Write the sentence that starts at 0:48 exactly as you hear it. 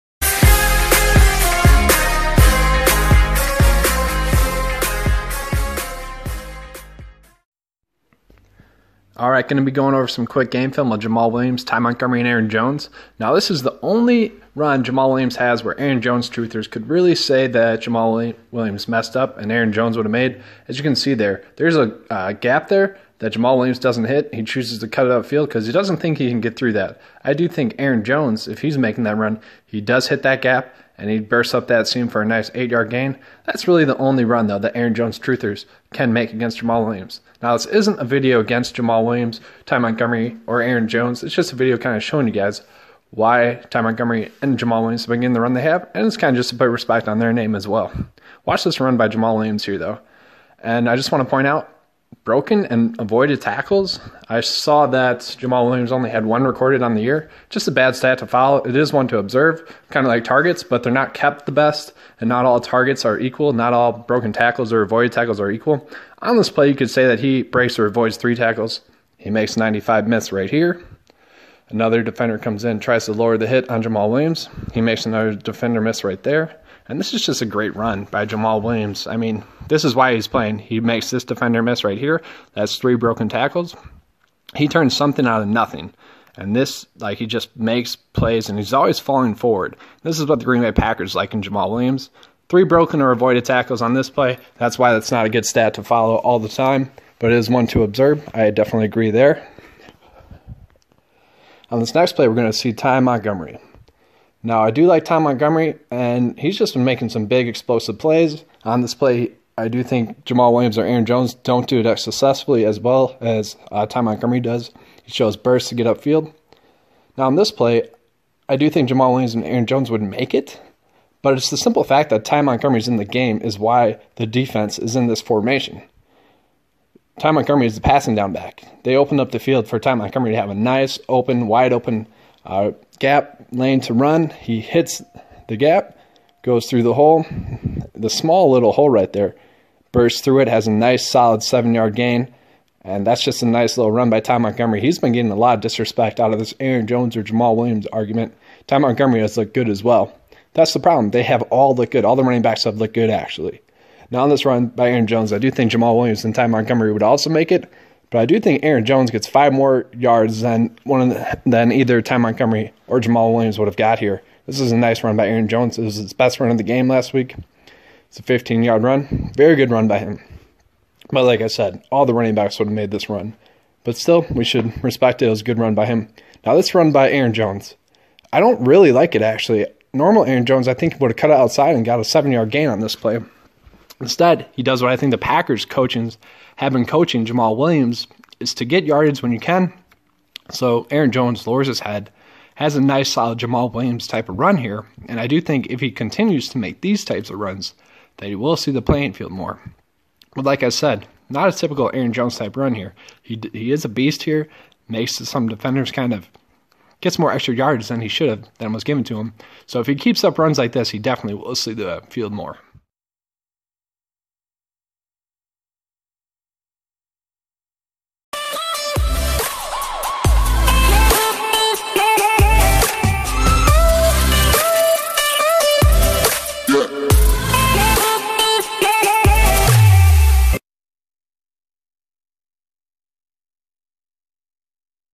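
Watch this run by Jamaal Williams here, though.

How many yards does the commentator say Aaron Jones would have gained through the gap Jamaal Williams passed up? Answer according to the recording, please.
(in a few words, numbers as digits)
8 yards.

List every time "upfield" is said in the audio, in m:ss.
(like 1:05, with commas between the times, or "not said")
0:25, 1:55.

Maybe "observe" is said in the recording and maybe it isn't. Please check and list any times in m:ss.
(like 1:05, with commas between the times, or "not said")
0:59, 1:37.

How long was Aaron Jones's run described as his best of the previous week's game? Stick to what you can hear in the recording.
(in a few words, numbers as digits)
15 yards.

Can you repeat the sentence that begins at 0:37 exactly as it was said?
Now, this isn't a video against Jamaal Williams, Ty Montgomery, or Aaron Jones.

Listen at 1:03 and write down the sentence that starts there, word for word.
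Not all broken tackles or avoided tackles are equal.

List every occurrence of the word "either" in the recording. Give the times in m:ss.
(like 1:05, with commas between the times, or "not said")
2:41.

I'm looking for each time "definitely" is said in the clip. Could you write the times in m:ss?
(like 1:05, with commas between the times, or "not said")
1:38, 3:30.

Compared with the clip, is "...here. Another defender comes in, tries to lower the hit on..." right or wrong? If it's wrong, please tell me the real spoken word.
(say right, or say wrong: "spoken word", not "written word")
right.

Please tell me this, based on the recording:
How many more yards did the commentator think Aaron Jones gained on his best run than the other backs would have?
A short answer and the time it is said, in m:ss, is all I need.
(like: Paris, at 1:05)
5, at 2:39.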